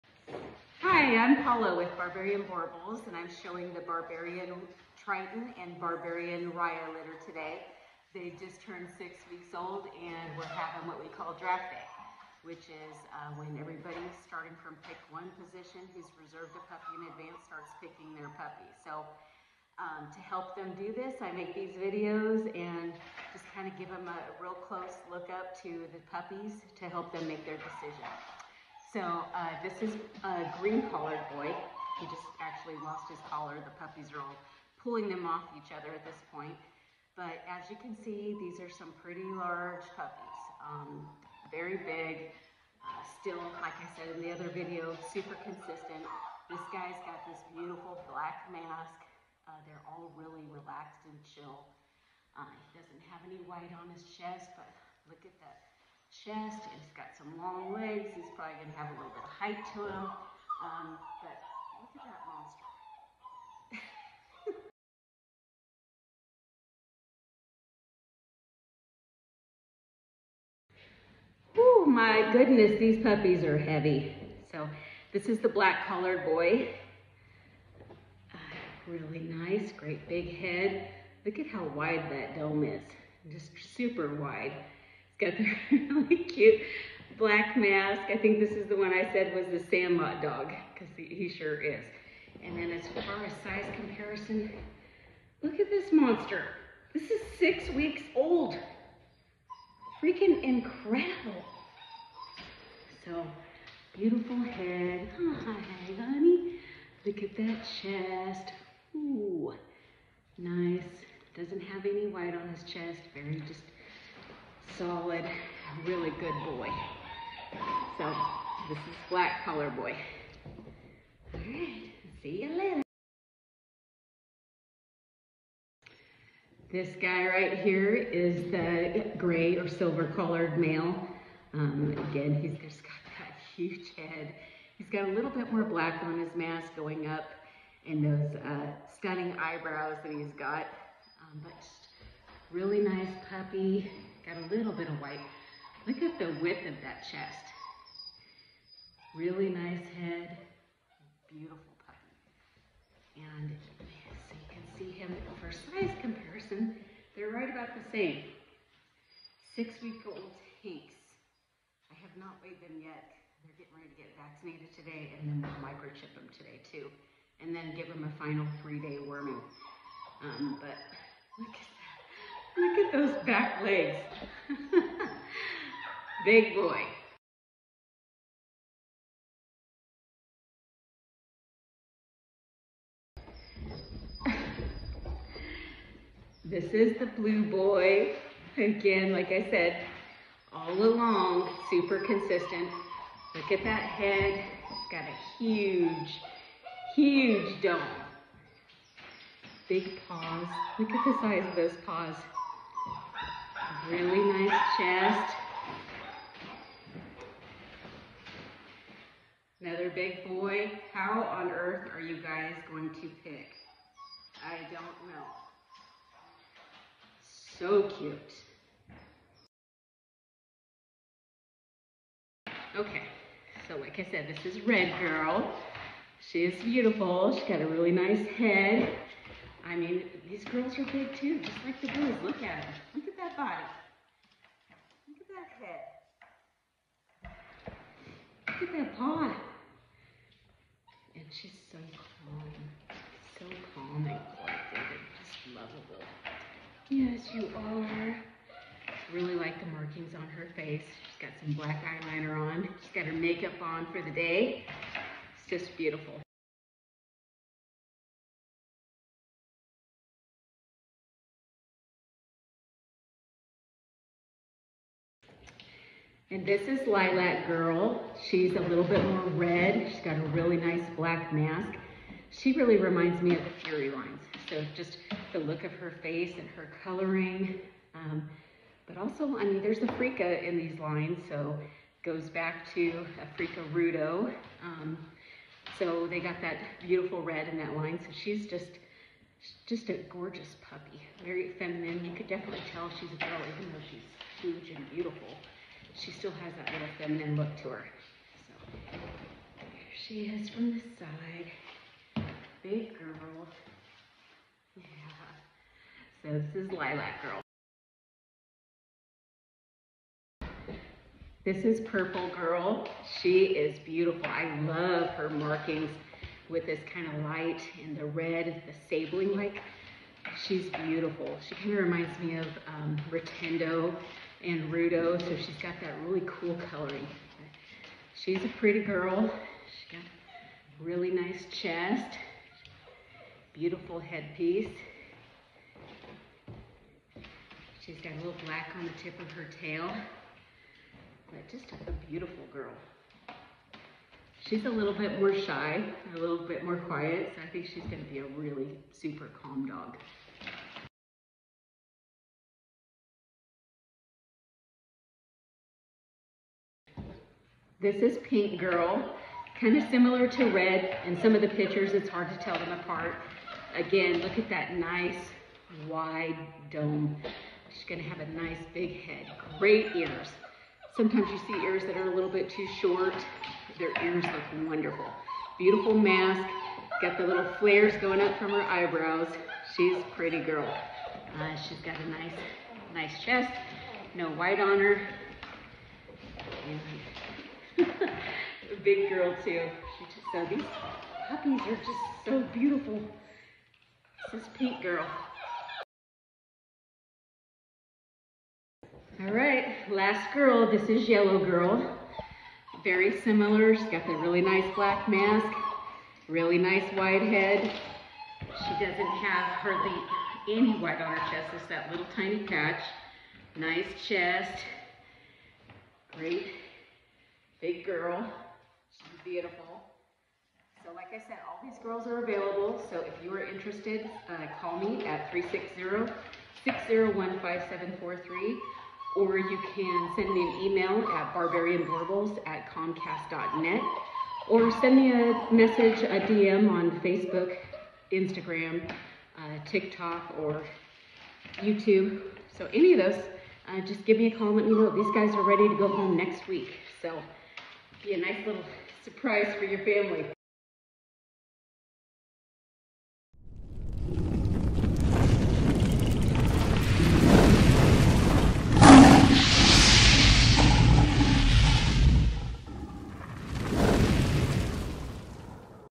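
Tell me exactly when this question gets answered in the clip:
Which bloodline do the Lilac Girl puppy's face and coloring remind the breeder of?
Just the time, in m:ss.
4:33.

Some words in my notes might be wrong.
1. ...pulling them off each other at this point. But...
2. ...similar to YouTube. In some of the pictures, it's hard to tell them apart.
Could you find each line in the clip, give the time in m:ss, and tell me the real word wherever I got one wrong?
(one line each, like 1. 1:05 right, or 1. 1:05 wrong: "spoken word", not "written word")
1. 0:34 right
2. 5:59 wrong: "Red", not "YouTube".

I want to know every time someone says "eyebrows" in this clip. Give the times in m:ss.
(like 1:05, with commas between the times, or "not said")
2:19, 6:18.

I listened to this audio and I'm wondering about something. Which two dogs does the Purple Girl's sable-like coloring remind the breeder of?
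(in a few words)
Rotendo and Rudo.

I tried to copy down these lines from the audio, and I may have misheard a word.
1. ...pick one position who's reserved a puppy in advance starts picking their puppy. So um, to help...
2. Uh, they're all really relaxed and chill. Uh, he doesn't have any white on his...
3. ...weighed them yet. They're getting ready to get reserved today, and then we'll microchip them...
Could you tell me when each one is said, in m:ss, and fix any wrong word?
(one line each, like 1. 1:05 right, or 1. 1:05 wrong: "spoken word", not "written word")
1. 0:14 right
2. 0:49 right
3. 2:42 wrong: "vaccinated", not "reserved".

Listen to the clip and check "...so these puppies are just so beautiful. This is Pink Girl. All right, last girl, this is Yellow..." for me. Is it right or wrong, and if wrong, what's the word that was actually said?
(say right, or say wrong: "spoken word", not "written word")
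right.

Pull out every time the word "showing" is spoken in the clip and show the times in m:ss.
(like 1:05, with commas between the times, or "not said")
0:03.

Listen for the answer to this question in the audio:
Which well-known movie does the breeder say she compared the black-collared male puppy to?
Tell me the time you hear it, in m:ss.
1:29.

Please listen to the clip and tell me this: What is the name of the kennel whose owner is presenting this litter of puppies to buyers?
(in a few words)
Barbarian Boerboels.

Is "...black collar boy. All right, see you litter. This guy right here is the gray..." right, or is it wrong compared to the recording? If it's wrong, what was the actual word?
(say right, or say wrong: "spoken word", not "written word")
wrong: "later", not "litter".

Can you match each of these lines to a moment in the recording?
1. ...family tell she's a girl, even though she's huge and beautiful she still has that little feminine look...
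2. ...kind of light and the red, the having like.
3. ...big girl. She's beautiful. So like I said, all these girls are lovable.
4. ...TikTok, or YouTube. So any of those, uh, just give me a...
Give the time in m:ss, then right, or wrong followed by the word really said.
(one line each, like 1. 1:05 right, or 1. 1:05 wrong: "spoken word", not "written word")
1. 4:52 wrong: "definitely", not "family"
2. 5:16 wrong: "sabling", not "having"
3. 6:57 wrong: "available", not "lovable"
4. 7:19 right.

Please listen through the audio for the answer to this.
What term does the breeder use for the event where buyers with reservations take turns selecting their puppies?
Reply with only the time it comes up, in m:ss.
0:11.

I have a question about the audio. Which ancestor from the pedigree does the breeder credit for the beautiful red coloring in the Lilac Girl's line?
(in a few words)
Frika Rudo.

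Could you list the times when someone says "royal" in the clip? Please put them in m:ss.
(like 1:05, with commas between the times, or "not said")
not said.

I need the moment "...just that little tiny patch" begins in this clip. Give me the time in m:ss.
6:51.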